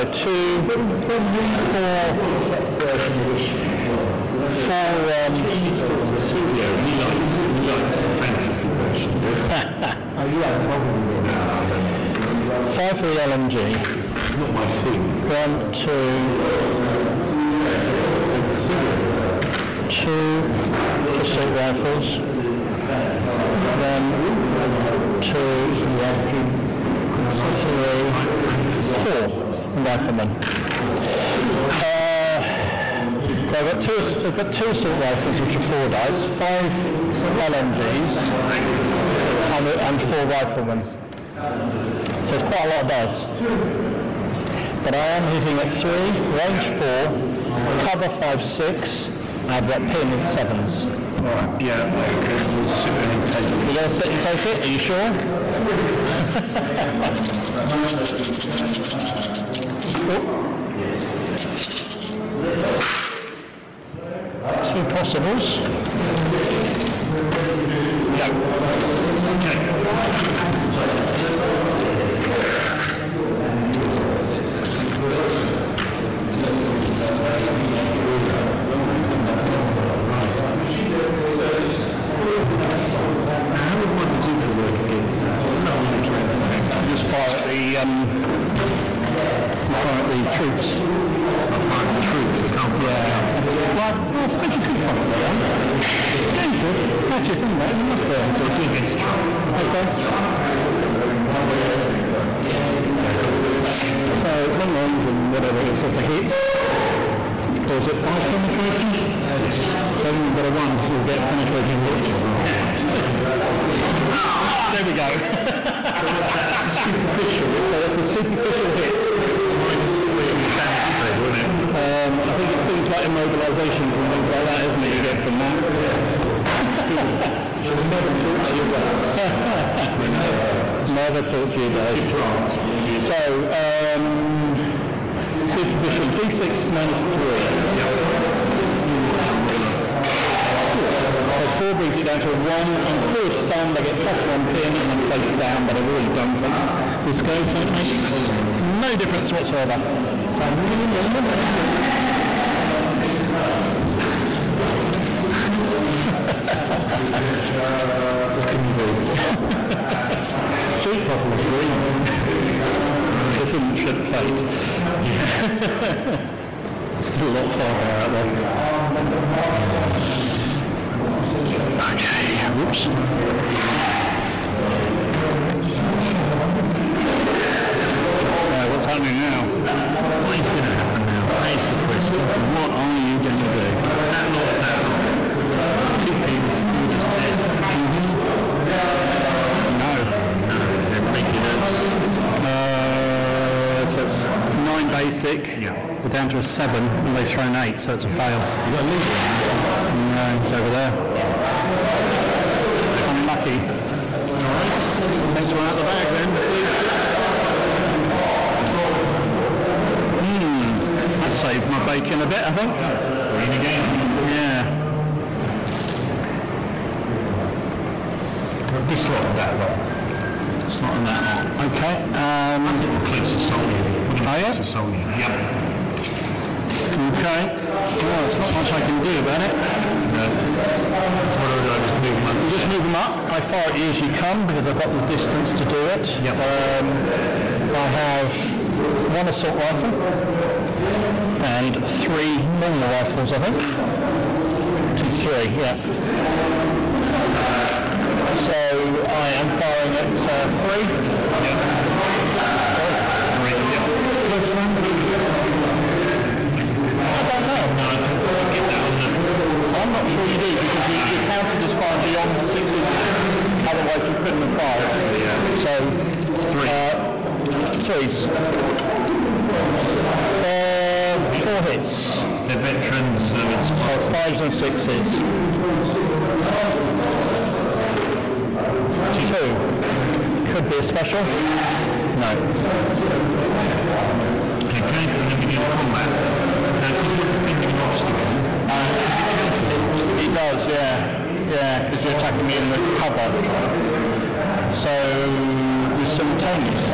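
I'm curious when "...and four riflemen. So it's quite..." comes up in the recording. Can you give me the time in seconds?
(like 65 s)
39 s.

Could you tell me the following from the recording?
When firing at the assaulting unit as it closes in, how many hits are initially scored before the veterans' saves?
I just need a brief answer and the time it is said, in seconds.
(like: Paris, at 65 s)
4, at 271 s.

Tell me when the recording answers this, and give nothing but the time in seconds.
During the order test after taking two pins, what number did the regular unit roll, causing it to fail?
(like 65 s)
197 s.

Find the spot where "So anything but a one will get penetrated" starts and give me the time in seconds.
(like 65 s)
109 s.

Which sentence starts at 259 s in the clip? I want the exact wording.
I'm not sure you do because you, are counted as firing yeah.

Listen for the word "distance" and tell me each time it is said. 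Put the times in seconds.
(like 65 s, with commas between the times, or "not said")
235 s.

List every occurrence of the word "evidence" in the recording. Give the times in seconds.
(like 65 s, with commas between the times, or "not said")
not said.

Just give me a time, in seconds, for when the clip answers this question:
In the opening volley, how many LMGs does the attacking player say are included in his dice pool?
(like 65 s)
36 s.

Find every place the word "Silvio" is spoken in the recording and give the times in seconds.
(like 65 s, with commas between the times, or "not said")
6 s, 18 s.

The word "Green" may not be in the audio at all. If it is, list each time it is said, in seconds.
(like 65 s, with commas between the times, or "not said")
78 s, 161 s, 213 s.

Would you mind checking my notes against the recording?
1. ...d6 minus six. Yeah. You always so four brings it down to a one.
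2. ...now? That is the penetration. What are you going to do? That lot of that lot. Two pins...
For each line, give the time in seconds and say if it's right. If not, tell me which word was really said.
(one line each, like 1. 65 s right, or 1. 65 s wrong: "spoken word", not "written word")
1. 136 s wrong: "three", not "six"
2. 181 s wrong: "question", not "penetration".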